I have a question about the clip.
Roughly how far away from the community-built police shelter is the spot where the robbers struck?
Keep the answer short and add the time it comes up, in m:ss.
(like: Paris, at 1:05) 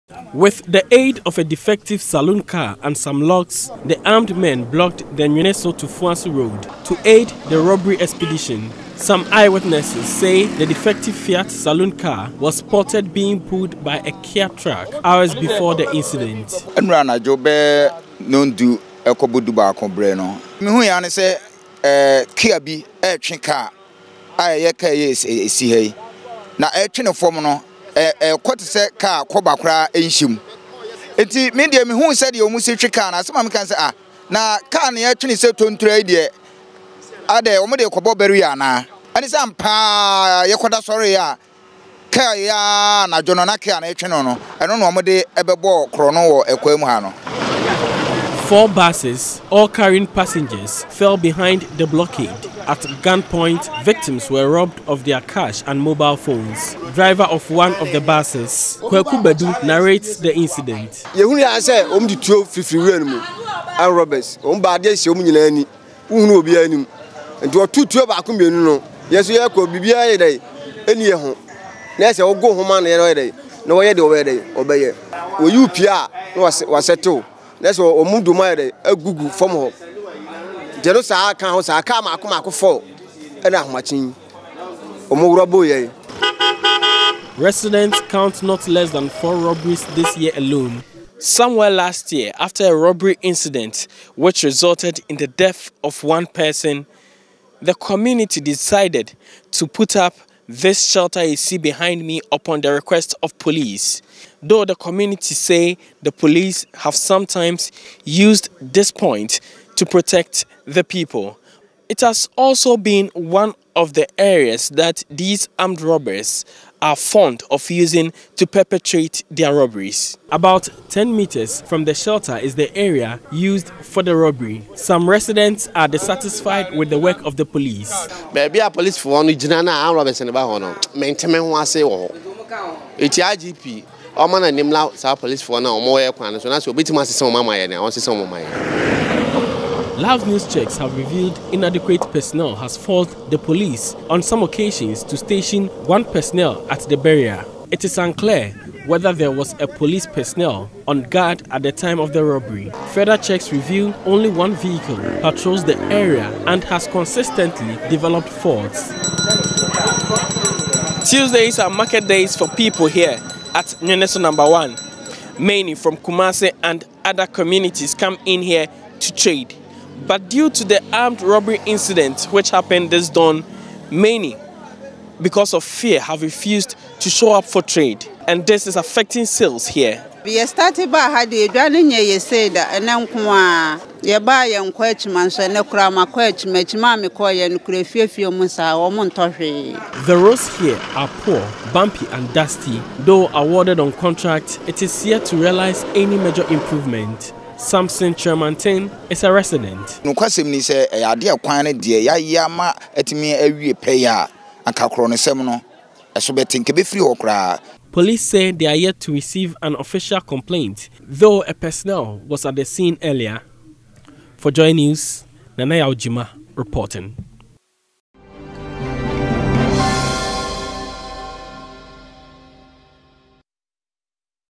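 10 meters, at 2:00.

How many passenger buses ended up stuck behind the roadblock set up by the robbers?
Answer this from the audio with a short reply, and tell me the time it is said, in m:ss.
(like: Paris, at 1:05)
4, at 0:48.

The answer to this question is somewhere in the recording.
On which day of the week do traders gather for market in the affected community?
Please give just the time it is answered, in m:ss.
2:41.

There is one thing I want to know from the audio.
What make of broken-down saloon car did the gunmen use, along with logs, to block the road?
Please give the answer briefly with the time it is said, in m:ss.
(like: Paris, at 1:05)
Fiat, at 0:11.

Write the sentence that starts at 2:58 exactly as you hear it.
And this is affecting sales here.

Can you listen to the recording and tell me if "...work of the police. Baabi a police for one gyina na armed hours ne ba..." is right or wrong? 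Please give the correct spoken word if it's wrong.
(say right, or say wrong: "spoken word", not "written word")
wrong: "robbers", not "hours".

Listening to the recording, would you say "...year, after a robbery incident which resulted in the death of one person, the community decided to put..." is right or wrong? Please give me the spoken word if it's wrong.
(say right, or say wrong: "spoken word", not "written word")
right.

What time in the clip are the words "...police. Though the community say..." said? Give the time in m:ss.
1:43.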